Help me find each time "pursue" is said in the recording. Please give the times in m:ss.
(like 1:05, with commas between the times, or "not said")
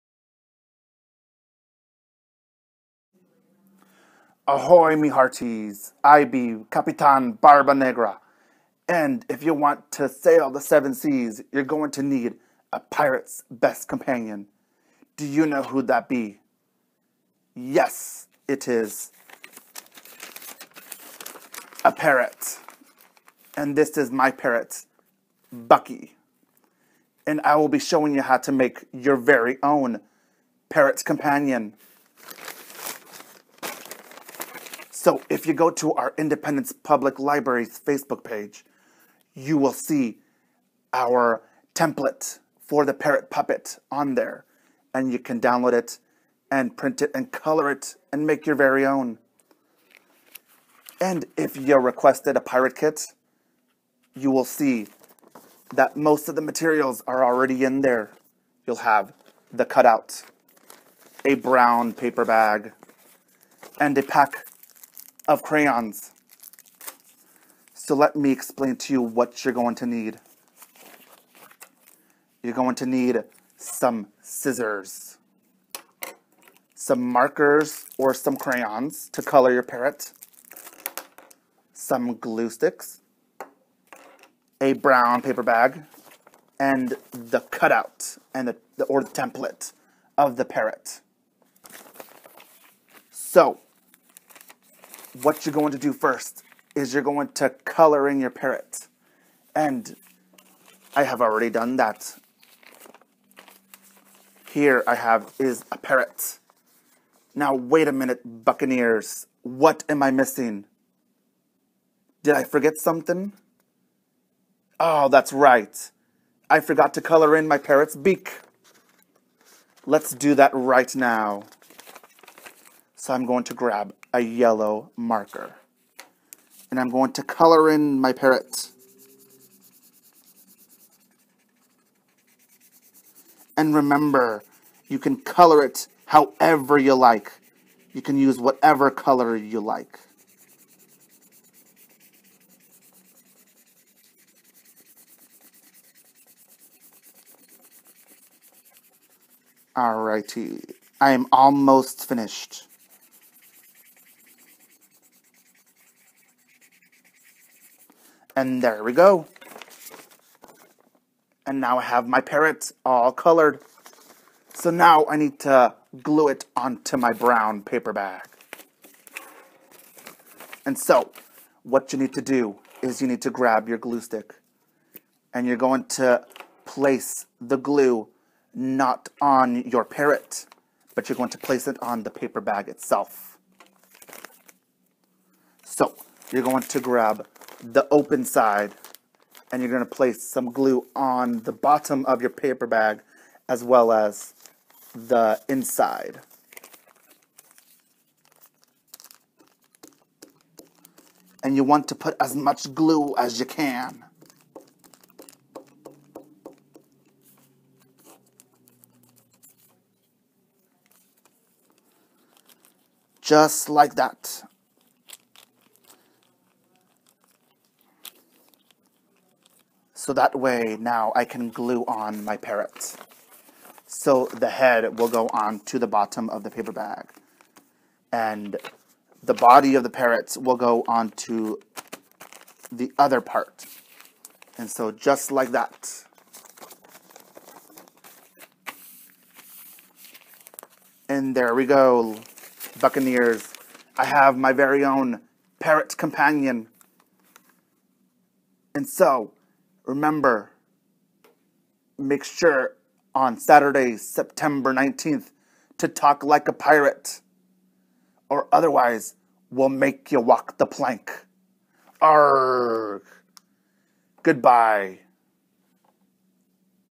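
not said.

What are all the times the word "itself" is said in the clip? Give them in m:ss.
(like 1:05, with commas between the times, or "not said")
3:02.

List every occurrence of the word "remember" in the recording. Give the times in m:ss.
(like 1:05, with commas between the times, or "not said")
2:13, 4:09.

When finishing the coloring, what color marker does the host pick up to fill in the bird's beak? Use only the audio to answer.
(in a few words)
Yellow.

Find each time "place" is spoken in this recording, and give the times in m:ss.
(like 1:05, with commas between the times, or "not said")
2:56, 3:01, 3:09.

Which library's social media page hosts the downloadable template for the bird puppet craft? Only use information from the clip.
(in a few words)
Independence Public Library.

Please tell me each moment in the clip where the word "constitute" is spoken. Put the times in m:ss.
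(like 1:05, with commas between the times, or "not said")
not said.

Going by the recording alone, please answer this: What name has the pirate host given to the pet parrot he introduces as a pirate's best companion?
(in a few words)
Bucky.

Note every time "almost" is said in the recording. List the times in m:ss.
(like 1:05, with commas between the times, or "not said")
2:31.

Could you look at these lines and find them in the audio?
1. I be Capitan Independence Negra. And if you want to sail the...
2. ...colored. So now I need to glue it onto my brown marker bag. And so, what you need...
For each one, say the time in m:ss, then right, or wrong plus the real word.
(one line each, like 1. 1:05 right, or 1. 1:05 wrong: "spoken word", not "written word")
1. 0:06 wrong: "Barba", not "Independence"
2. 2:43 wrong: "paper", not "marker".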